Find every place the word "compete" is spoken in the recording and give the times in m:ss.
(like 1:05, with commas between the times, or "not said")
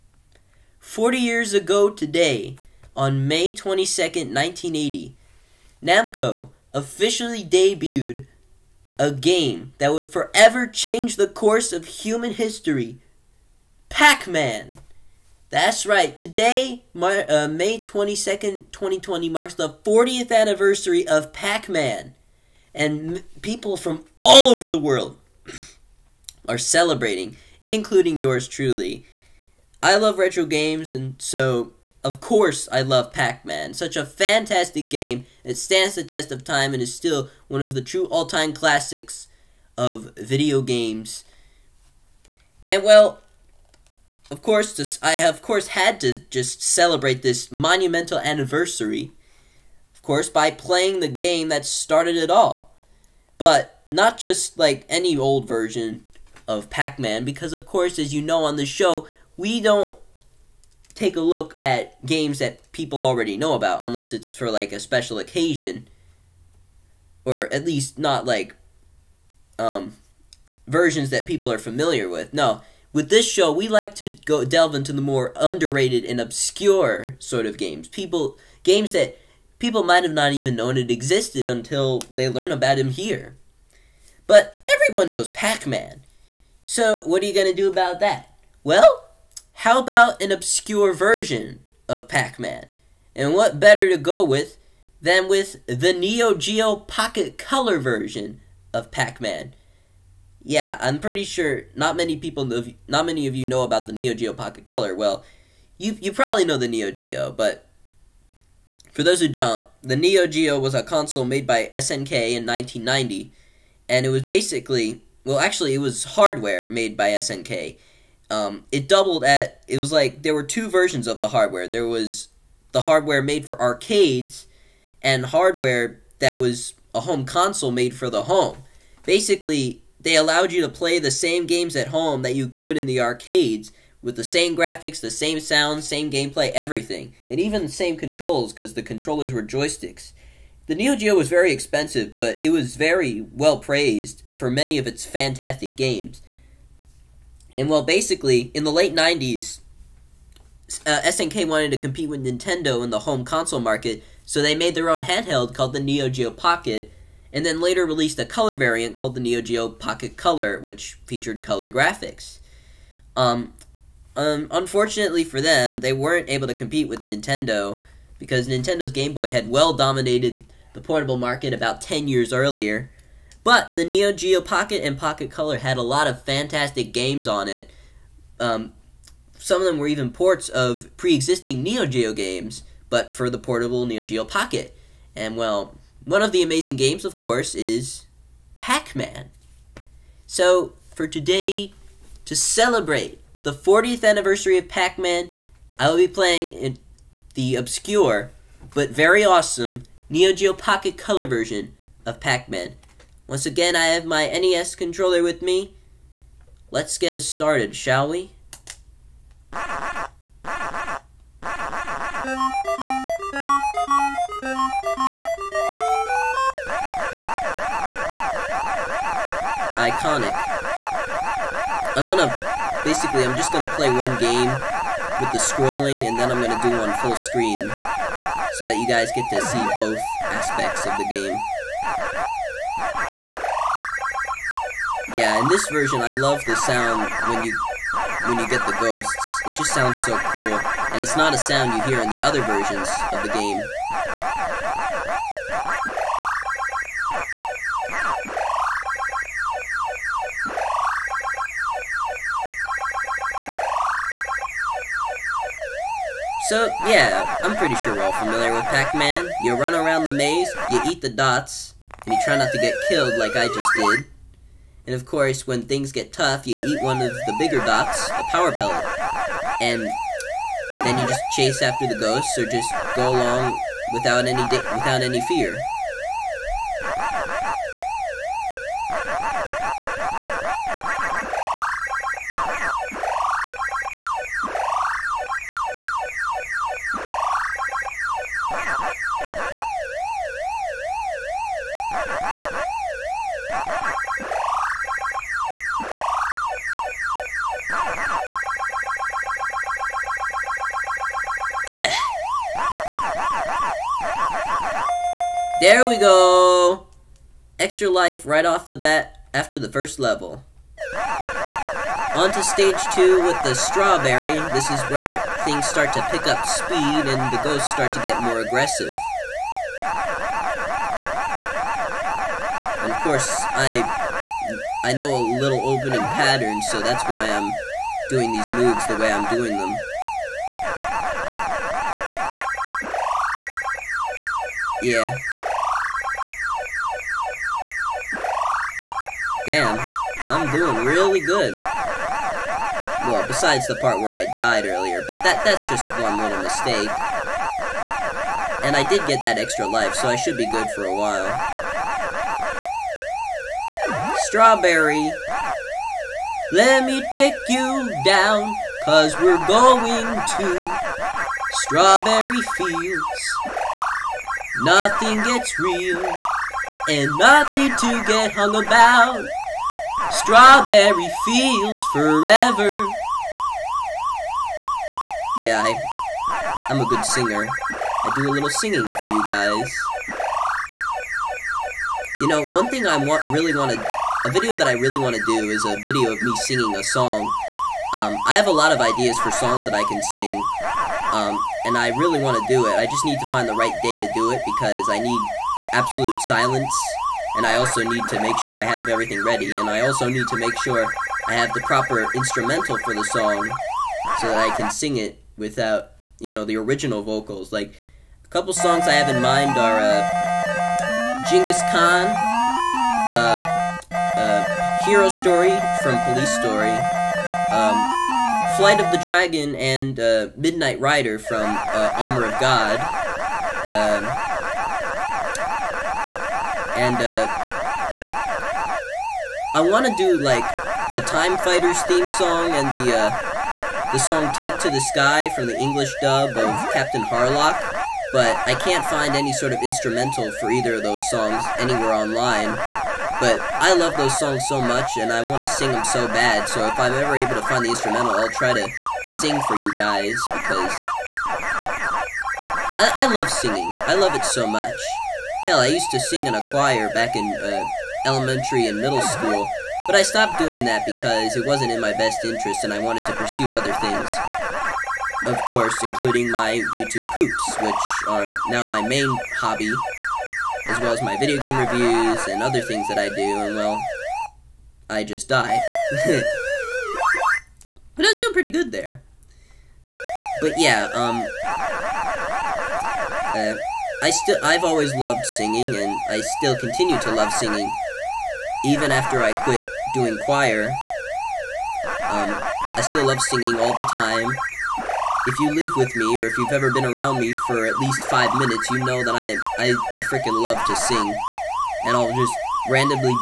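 2:31, 2:46.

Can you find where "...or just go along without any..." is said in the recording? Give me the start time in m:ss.
4:32.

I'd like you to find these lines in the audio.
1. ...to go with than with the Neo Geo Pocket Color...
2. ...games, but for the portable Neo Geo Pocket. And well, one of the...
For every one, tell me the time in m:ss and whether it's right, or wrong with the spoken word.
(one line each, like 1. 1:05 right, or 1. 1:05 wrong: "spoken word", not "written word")
1. 1:33 right
2. 3:02 right.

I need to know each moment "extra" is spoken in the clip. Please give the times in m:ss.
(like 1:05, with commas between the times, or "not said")
5:07, 5:49.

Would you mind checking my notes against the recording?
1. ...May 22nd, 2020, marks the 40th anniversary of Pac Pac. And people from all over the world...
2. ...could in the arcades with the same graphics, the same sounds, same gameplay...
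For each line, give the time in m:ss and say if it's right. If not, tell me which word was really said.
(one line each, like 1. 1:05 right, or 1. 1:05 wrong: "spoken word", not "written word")
1. 0:17 wrong: "Man", not "Pac"
2. 2:12 right.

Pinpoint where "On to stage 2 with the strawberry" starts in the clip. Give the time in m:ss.
5:12.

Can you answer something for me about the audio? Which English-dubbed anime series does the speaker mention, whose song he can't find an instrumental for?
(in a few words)
Captain Harlock.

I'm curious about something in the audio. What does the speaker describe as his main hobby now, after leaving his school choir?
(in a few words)
YouTube poops.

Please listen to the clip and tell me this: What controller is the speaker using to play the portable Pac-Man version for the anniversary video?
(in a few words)
NES controller.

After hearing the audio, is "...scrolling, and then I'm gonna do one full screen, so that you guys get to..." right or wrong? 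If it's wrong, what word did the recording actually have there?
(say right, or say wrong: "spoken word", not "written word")
right.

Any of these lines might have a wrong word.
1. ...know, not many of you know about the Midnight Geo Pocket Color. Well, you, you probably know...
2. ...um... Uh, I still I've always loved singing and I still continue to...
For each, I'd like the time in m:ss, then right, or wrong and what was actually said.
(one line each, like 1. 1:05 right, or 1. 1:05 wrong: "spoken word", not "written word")
1. 1:42 wrong: "Neo", not "Midnight"
2. 8:00 right.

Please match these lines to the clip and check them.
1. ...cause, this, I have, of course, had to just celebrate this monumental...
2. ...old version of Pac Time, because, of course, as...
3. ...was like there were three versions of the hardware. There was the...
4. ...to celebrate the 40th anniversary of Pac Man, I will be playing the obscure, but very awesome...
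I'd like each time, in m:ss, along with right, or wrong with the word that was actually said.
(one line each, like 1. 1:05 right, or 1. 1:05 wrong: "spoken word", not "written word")
1. 0:44 wrong: "course", not "cause"
2. 0:55 wrong: "Man", not "Time"
3. 1:59 wrong: "two", not "three"
4. 3:12 right.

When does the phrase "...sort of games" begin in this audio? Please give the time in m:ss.
1:17.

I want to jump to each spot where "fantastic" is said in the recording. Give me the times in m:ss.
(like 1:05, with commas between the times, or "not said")
0:34, 2:25, 2:56.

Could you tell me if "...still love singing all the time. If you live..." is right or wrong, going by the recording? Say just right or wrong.
right.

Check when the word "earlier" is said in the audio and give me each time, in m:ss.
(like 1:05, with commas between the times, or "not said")
2:52, 5:44.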